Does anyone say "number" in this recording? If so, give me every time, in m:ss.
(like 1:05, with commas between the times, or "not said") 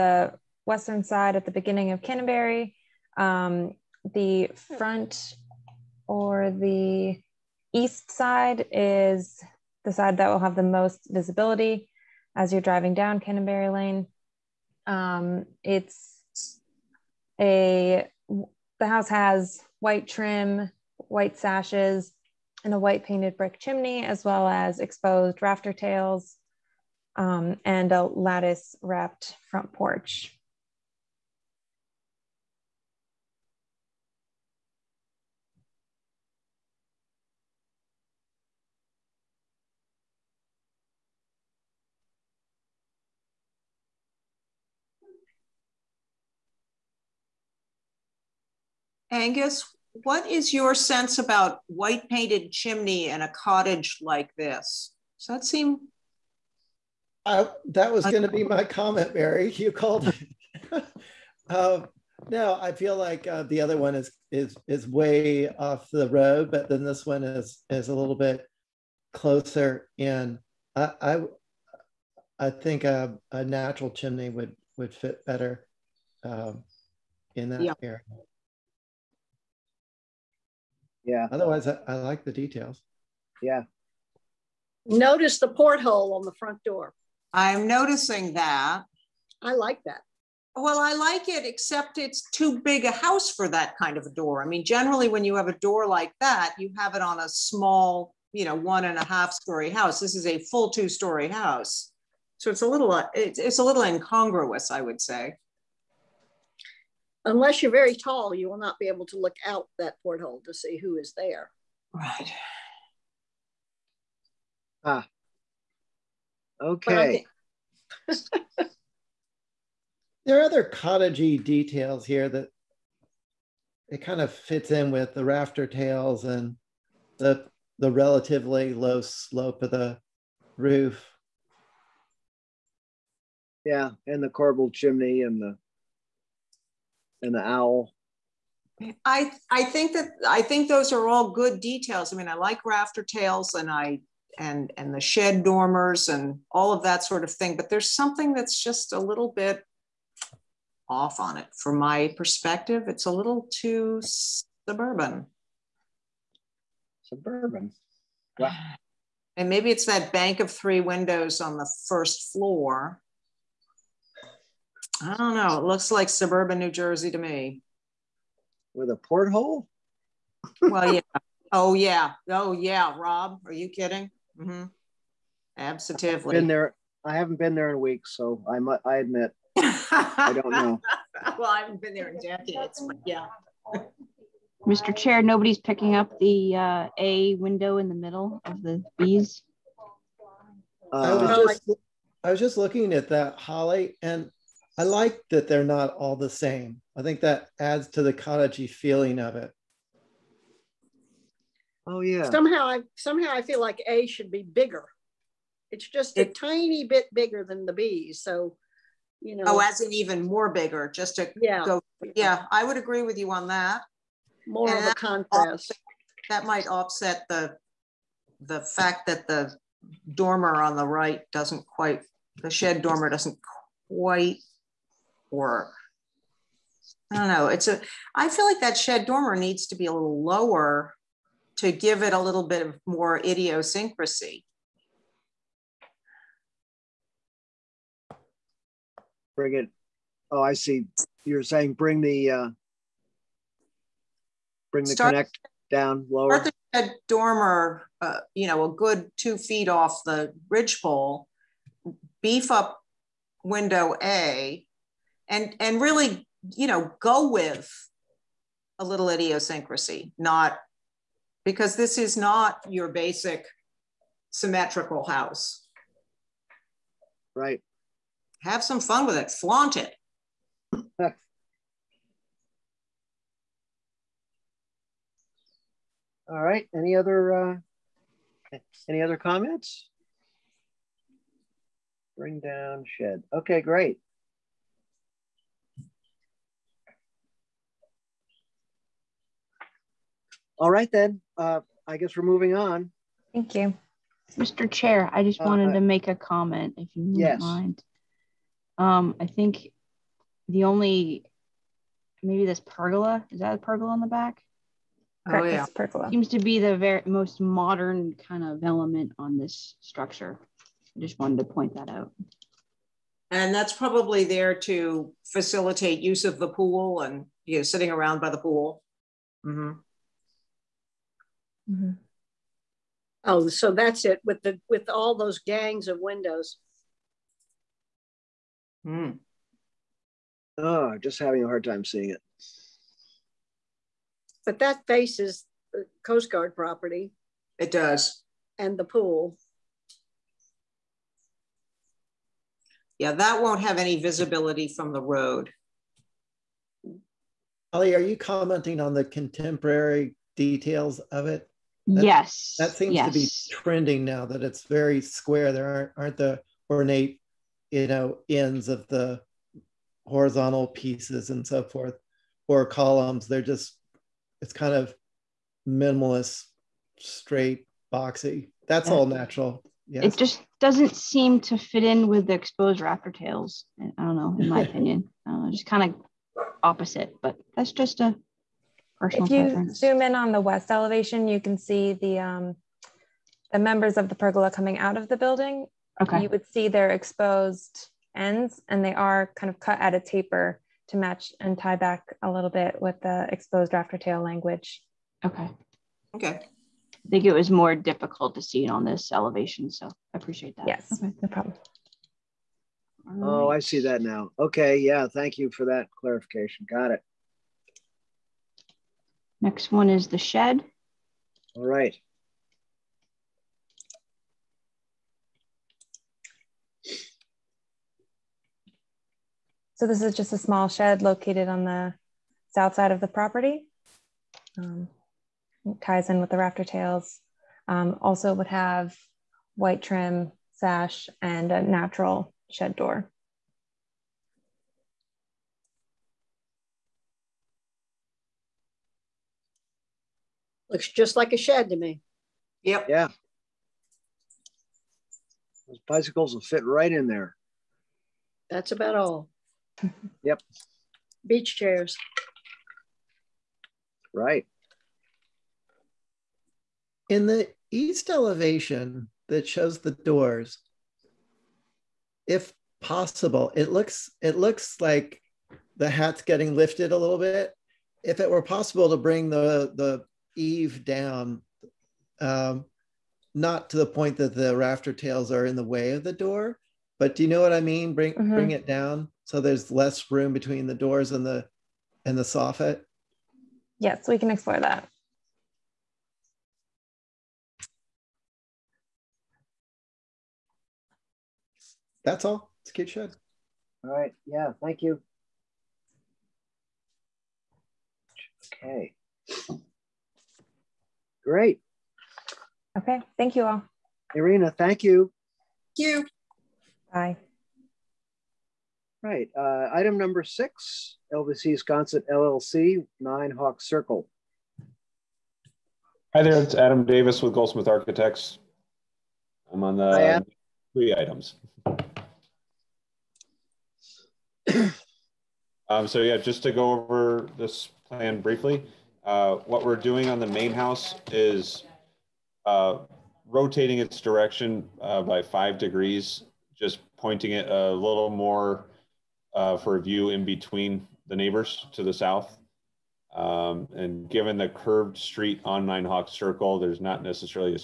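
8:29.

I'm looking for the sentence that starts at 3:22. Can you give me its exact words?
Somehow I somehow I feel like A should be bigger.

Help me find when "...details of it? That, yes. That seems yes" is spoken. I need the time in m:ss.
5:50.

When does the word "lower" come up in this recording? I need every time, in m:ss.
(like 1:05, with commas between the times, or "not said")
3:50, 4:06.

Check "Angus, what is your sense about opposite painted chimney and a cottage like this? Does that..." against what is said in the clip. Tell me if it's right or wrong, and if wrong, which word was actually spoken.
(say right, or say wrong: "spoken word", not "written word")
wrong: "white", not "opposite".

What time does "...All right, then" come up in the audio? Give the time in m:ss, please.
4:50.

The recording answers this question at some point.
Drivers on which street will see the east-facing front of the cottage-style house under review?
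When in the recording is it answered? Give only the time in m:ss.
0:13.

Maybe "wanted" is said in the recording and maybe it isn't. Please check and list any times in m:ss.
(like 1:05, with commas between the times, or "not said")
4:55, 5:11.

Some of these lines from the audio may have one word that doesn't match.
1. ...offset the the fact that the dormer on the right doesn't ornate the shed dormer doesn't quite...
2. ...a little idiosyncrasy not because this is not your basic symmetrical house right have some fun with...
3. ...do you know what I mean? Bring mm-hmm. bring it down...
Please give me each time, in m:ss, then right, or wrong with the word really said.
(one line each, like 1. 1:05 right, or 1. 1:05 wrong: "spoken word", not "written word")
1. 3:36 wrong: "quite", not "ornate"
2. 4:18 right
3. 7:57 right.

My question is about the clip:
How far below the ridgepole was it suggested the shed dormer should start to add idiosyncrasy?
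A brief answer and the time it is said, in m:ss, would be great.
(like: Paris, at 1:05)
two feet, at 4:09.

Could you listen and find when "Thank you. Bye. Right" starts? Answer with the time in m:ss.
8:25.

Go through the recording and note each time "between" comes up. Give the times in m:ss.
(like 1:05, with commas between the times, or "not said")
8:00, 9:00.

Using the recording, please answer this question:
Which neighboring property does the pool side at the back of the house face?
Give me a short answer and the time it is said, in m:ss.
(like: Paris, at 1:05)
Coast Guard, at 5:36.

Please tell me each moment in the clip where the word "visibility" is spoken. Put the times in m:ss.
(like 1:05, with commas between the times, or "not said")
0:11, 5:44.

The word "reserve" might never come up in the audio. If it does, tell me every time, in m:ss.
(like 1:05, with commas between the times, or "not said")
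not said.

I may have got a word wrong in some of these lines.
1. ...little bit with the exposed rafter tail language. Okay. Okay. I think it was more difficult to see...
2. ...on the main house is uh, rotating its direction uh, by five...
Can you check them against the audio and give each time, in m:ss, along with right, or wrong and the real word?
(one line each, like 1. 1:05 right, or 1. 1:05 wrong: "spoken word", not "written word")
1. 6:32 right
2. 8:50 right.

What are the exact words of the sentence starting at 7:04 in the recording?
Um, ties in with the rafter tails.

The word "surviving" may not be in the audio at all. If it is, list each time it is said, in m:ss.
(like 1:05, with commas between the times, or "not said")
not said.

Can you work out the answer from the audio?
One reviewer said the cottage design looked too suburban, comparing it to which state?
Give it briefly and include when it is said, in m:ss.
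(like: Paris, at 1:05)
New Jersey, at 2:46.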